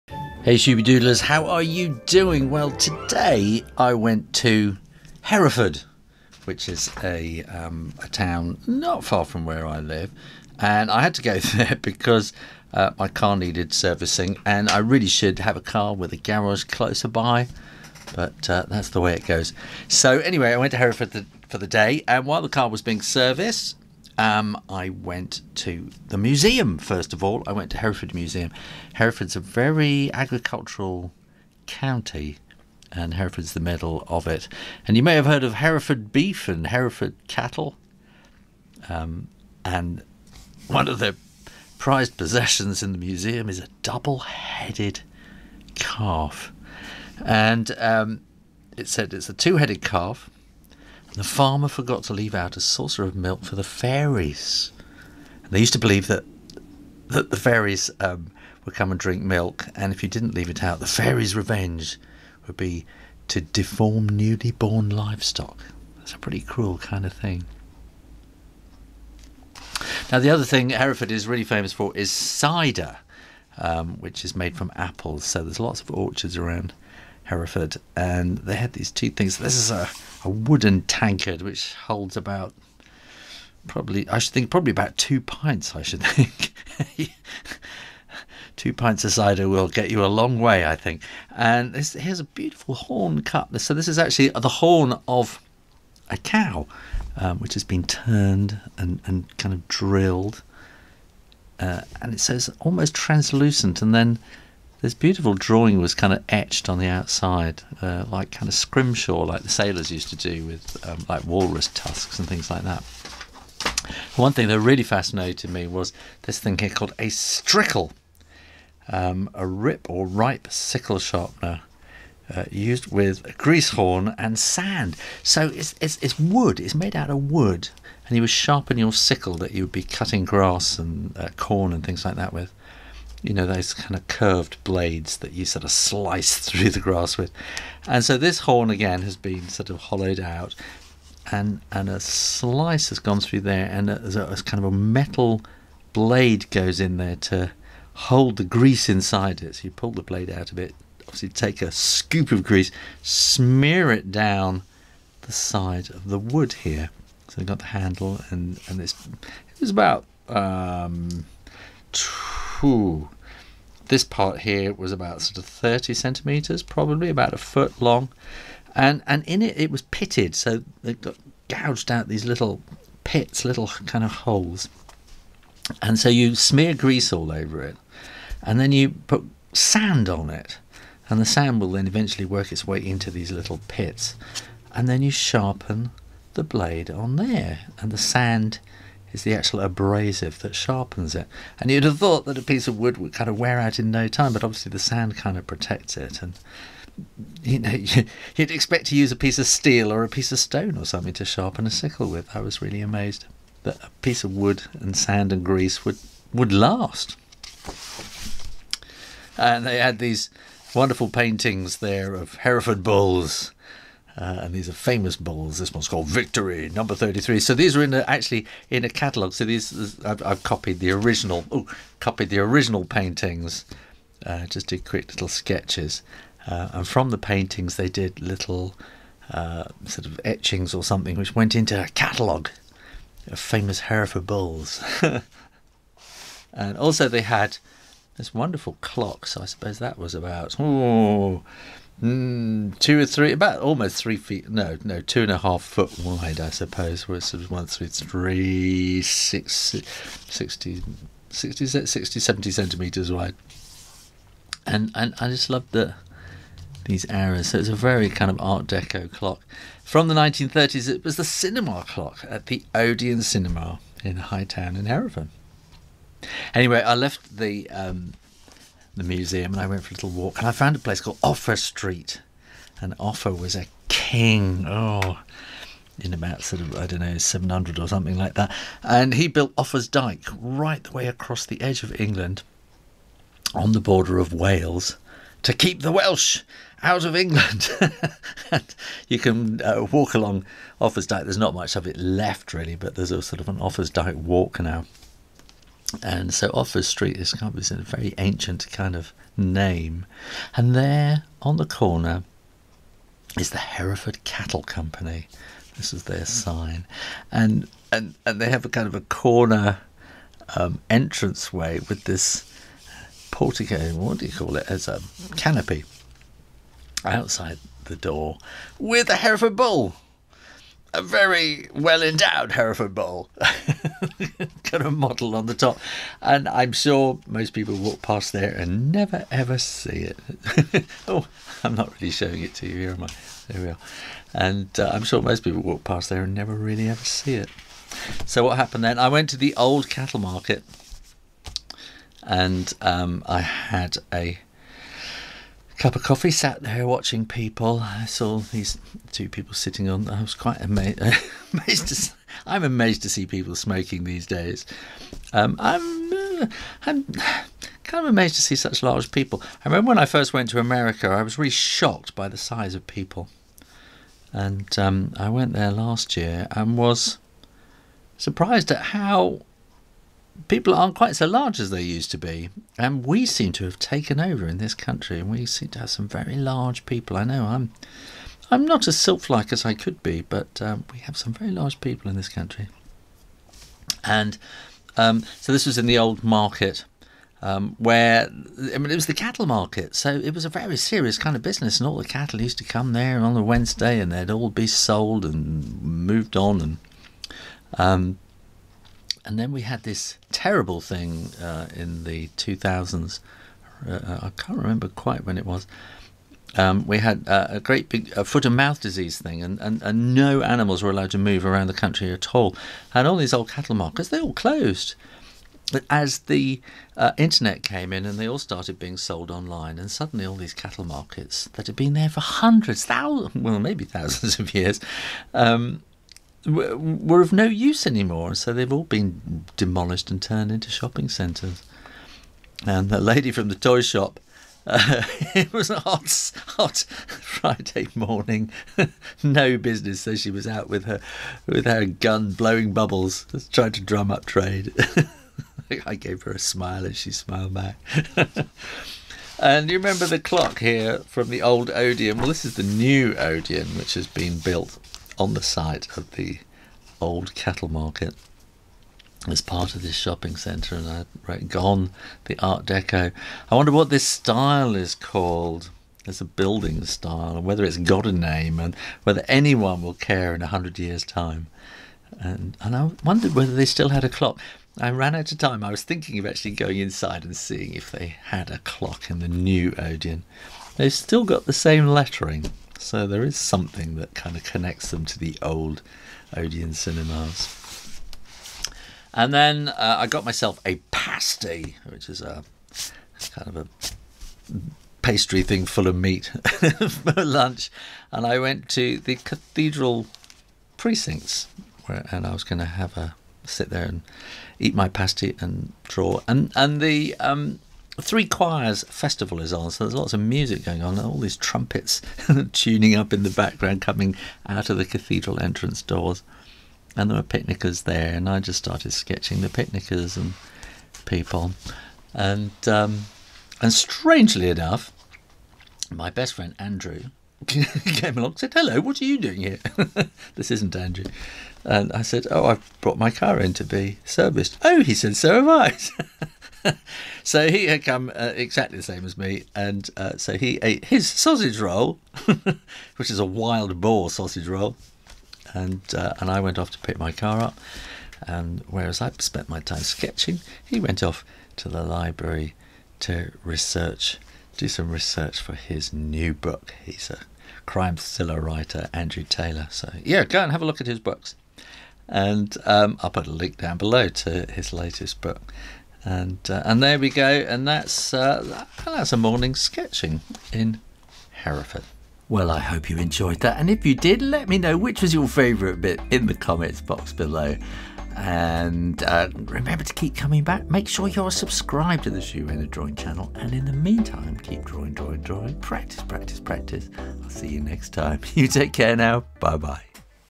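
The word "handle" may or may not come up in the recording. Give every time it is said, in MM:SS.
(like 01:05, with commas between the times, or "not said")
02:37.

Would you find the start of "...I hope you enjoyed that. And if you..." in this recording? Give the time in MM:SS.
09:32.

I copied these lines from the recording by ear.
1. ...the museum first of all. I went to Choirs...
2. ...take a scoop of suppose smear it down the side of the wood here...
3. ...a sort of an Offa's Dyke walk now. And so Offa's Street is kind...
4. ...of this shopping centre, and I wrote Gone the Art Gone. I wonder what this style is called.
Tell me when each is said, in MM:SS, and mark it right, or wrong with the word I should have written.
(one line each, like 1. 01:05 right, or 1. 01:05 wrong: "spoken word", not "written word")
1. 00:26 wrong: "Hereford", not "Choirs"
2. 02:31 wrong: "grease", not "suppose"
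3. 04:53 right
4. 07:39 wrong: "Deco", not "Gone".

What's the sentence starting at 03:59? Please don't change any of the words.
So I suppose that was about oh, mm, two or three, about almost three feet.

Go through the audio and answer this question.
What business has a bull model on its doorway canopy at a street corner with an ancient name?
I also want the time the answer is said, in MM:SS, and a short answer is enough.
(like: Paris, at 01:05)
Hereford Cattle Company, at 05:03.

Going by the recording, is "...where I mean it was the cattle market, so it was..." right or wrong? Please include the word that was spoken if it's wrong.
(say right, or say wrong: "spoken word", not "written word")
right.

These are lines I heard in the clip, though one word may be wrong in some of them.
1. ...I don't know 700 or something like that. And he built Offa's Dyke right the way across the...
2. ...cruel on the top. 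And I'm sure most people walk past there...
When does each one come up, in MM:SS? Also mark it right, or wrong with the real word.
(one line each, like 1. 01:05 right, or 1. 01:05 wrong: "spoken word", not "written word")
1. 04:36 right
2. 05:24 wrong: "model", not "cruel".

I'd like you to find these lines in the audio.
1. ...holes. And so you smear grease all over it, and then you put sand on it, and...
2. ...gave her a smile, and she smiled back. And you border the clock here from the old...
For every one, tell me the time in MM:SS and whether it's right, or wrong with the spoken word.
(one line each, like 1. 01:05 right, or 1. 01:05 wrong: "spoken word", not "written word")
1. 02:54 right
2. 07:25 wrong: "remember", not "border".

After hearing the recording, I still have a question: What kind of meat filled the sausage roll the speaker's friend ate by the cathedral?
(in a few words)
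wild boar.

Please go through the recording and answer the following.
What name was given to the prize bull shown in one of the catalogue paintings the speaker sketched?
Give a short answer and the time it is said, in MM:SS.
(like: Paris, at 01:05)
Victory Number 33, at 03:36.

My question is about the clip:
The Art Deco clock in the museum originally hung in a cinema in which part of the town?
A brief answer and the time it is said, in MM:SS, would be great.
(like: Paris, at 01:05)
High Town, at 04:24.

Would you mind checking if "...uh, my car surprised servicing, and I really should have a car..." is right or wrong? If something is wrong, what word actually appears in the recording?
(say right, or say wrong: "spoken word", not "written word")
wrong: "needed", not "surprised".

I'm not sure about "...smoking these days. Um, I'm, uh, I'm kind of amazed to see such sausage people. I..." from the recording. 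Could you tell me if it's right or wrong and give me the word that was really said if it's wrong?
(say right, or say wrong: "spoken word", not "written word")
wrong: "large", not "sausage".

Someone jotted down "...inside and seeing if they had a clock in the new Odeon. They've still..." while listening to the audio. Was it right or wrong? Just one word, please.
right.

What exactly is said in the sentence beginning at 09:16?
He's a crime thriller writer, Andrew Taylor.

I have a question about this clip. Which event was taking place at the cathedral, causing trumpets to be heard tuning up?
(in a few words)
Three Choirs Festival.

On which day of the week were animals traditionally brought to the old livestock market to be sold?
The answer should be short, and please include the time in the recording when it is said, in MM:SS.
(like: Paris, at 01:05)
Wednesday, at 06:33.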